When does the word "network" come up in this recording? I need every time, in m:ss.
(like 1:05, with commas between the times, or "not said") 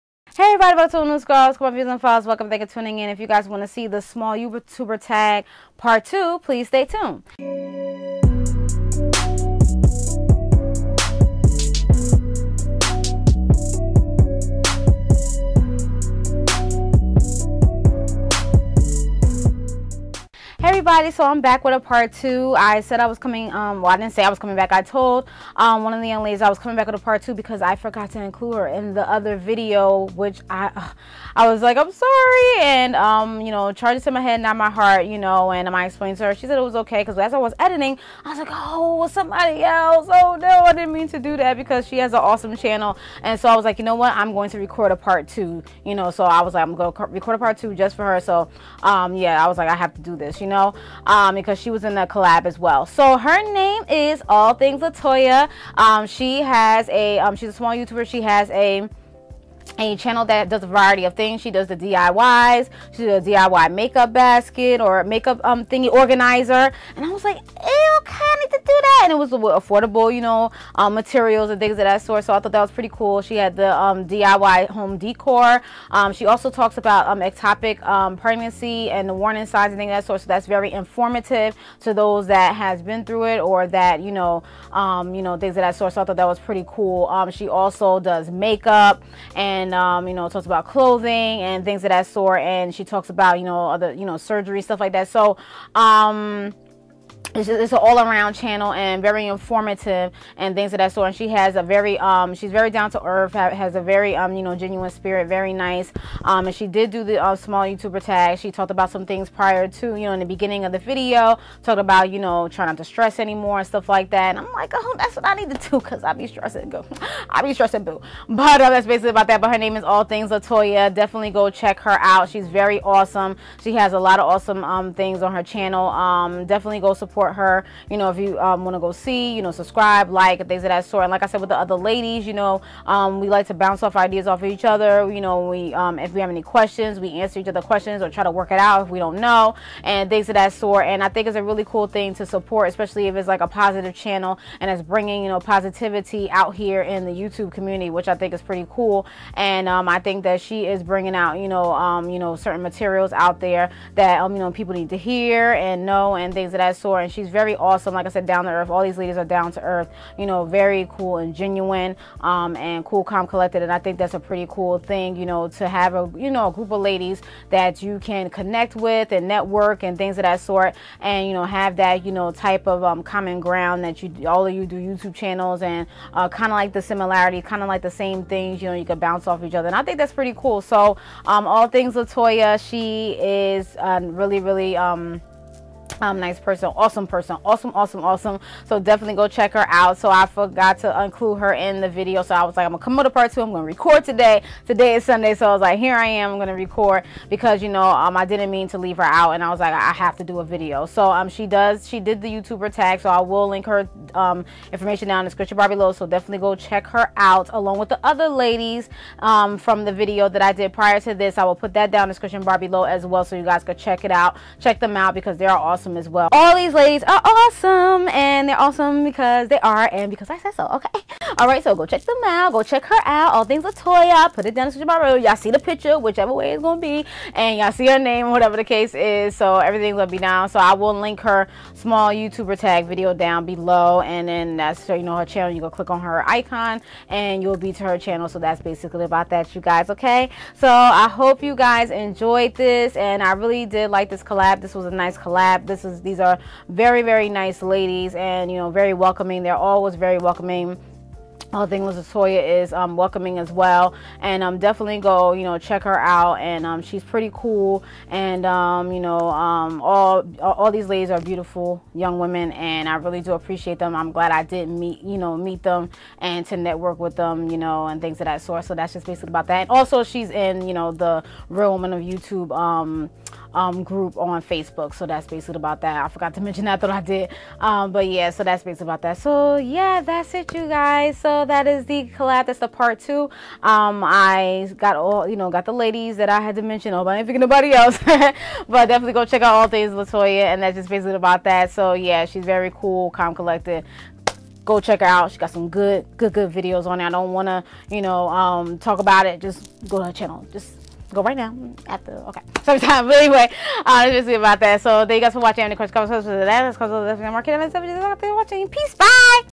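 2:49, 4:26.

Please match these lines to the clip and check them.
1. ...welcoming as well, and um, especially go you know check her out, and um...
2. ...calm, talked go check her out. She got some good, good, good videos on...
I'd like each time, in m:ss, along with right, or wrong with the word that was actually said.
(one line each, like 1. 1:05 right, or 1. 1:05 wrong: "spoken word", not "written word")
1. 4:12 wrong: "definitely", not "especially"
2. 4:53 wrong: "collected", not "talked".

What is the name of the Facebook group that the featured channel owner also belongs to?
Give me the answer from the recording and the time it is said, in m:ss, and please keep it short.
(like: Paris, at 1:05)
Real Woman of YouTube, at 4:31.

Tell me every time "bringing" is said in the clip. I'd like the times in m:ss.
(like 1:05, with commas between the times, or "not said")
2:24, 2:30.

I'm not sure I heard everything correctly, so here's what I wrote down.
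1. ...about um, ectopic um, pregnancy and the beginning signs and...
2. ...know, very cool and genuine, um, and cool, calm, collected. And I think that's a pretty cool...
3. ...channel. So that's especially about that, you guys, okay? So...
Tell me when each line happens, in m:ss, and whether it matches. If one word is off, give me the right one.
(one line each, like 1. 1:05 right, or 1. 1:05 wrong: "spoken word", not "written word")
1. 1:16 wrong: "warning", not "beginning"
2. 2:40 right
3. 3:57 wrong: "basically", not "especially".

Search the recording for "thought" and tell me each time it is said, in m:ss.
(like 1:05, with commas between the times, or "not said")
1:12, 1:26.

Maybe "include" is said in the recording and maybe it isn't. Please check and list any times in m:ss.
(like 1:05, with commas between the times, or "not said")
0:28, 3:11.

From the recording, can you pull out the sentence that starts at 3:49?
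So everything's going to be down.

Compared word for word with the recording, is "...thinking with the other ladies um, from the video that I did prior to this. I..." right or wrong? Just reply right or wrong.
wrong.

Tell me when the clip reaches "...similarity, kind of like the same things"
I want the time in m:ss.
2:56.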